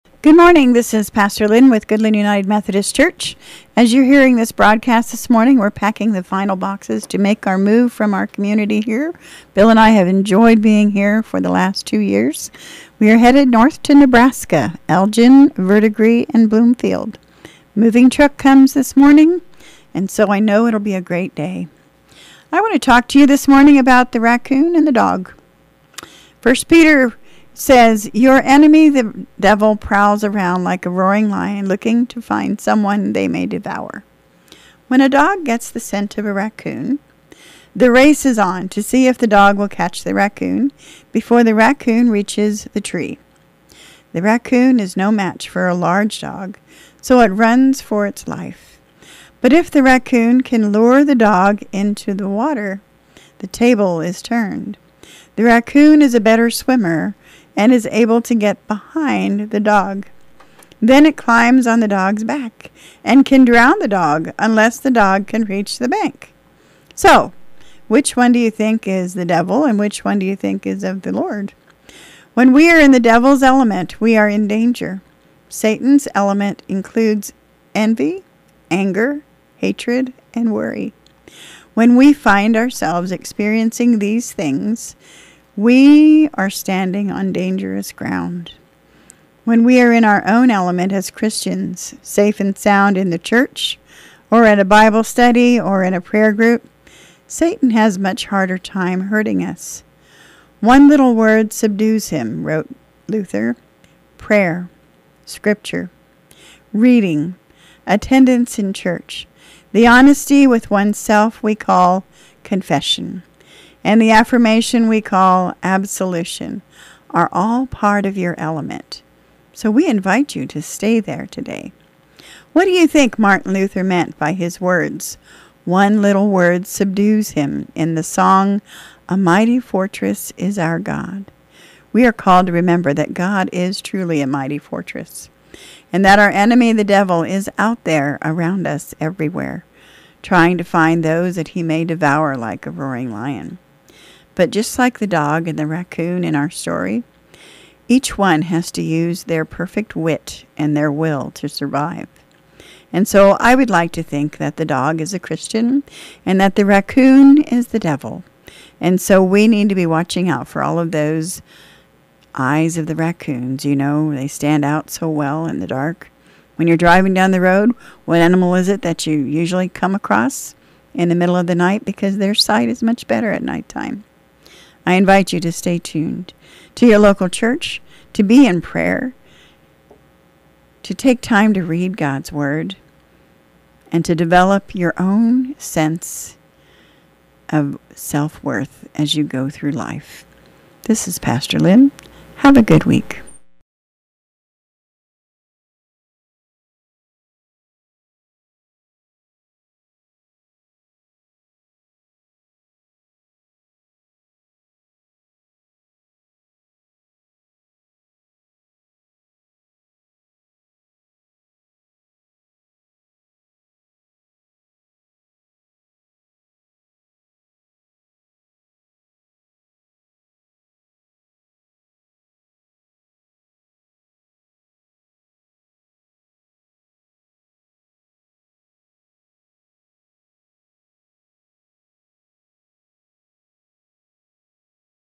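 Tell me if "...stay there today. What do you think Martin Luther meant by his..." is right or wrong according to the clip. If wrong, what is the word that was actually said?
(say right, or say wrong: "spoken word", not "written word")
right.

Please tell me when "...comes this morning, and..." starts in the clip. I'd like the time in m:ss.
0:18.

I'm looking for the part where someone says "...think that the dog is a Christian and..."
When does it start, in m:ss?
2:34.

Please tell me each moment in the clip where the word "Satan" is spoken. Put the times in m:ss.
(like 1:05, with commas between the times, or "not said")
1:15, 1:37.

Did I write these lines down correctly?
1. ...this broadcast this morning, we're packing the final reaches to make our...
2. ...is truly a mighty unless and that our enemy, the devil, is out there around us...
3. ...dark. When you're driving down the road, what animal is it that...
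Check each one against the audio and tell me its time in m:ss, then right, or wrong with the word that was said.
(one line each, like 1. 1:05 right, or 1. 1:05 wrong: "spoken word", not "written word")
1. 0:04 wrong: "boxes", not "reaches"
2. 2:13 wrong: "fortress", not "unless"
3. 2:45 right.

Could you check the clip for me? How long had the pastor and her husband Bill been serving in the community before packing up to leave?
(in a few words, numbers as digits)
2 years.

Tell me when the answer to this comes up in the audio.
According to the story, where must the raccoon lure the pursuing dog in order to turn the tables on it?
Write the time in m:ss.
0:52.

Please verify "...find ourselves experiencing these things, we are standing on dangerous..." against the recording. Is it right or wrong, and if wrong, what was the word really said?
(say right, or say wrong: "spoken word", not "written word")
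right.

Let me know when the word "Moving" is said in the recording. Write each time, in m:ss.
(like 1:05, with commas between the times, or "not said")
0:17.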